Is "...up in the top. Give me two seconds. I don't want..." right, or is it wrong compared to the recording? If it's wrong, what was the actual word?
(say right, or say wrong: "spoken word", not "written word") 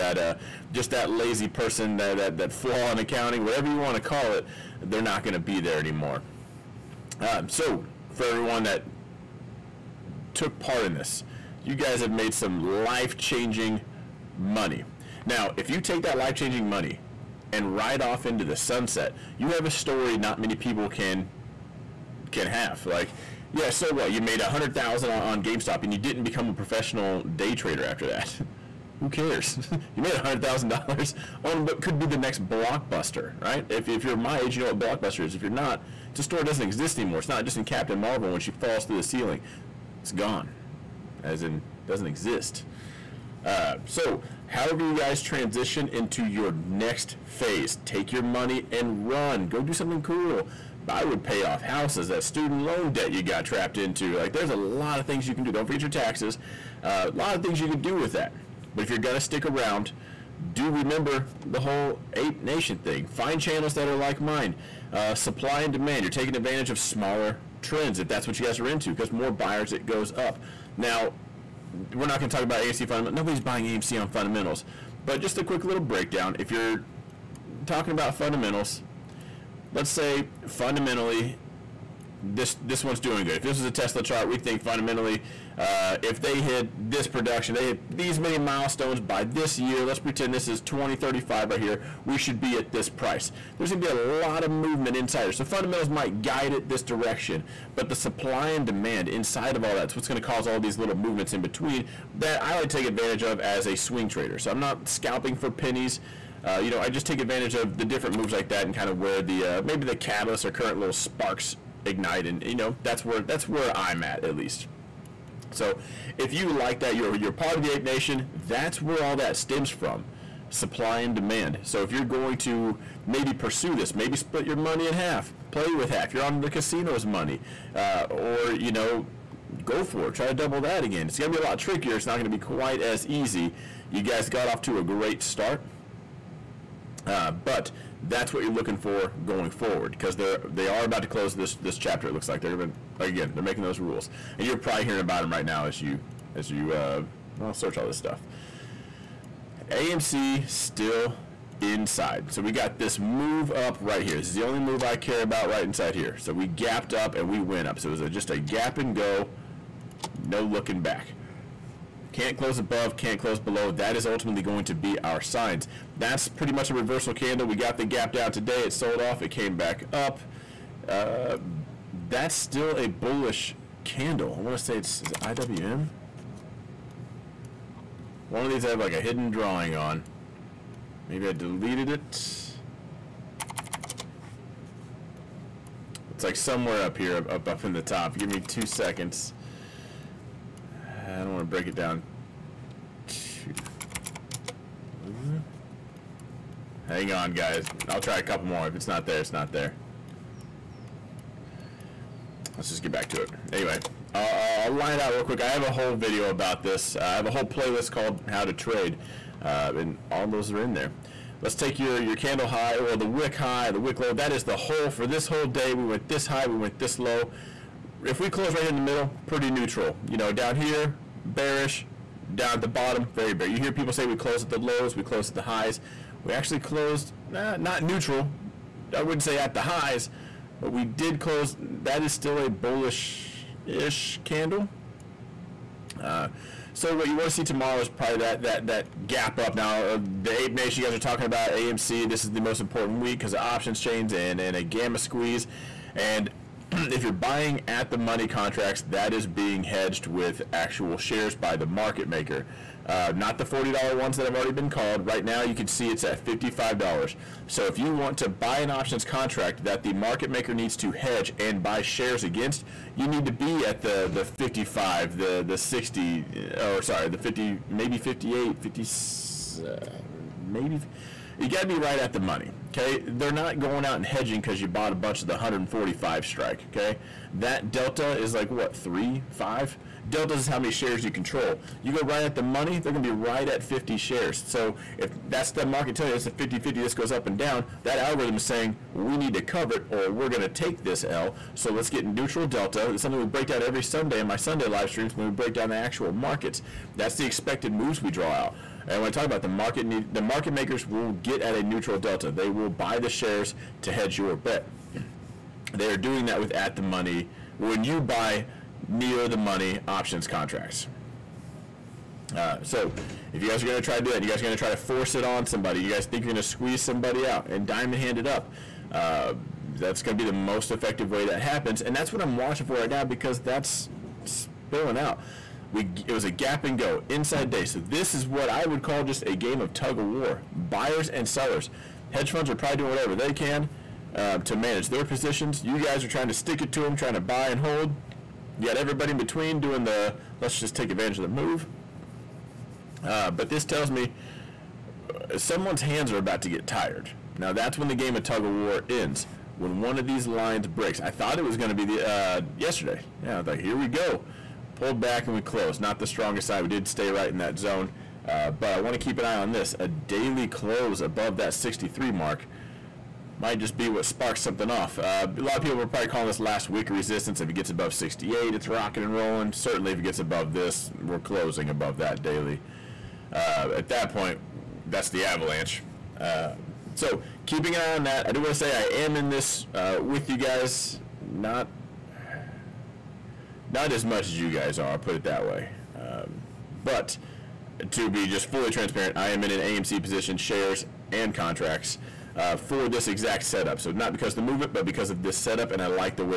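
right.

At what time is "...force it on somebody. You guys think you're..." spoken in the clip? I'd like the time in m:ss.
5:14.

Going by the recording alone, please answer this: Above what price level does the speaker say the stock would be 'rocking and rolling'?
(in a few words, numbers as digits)
68.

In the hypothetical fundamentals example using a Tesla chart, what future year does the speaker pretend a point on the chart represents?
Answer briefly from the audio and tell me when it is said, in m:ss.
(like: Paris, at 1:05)
2035, at 1:30.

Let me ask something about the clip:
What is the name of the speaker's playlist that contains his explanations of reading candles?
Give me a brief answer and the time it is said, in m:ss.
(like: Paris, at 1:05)
How to Trade, at 3:28.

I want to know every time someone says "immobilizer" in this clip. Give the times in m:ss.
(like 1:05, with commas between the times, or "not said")
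not said.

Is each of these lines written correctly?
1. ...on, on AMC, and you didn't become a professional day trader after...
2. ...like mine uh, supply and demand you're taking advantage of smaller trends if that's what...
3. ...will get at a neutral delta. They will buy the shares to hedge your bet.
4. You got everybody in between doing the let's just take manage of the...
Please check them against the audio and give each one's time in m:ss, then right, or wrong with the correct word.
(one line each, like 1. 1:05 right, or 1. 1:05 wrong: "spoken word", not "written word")
1. 0:25 wrong: "GameStop", not "AMC"
2. 1:03 right
3. 5:00 right
4. 5:38 wrong: "advantage", not "manage".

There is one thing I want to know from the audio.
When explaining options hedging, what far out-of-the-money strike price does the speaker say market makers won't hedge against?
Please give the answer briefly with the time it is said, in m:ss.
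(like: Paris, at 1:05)
145, at 4:35.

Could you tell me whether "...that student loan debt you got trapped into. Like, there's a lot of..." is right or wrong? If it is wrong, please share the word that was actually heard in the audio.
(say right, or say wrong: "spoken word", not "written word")
right.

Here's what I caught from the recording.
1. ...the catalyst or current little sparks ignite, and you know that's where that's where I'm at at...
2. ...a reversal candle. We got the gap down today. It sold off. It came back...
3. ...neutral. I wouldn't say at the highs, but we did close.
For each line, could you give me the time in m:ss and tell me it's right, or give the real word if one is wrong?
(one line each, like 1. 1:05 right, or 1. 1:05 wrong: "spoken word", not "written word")
1. 1:49 right
2. 2:46 right
3. 3:47 right.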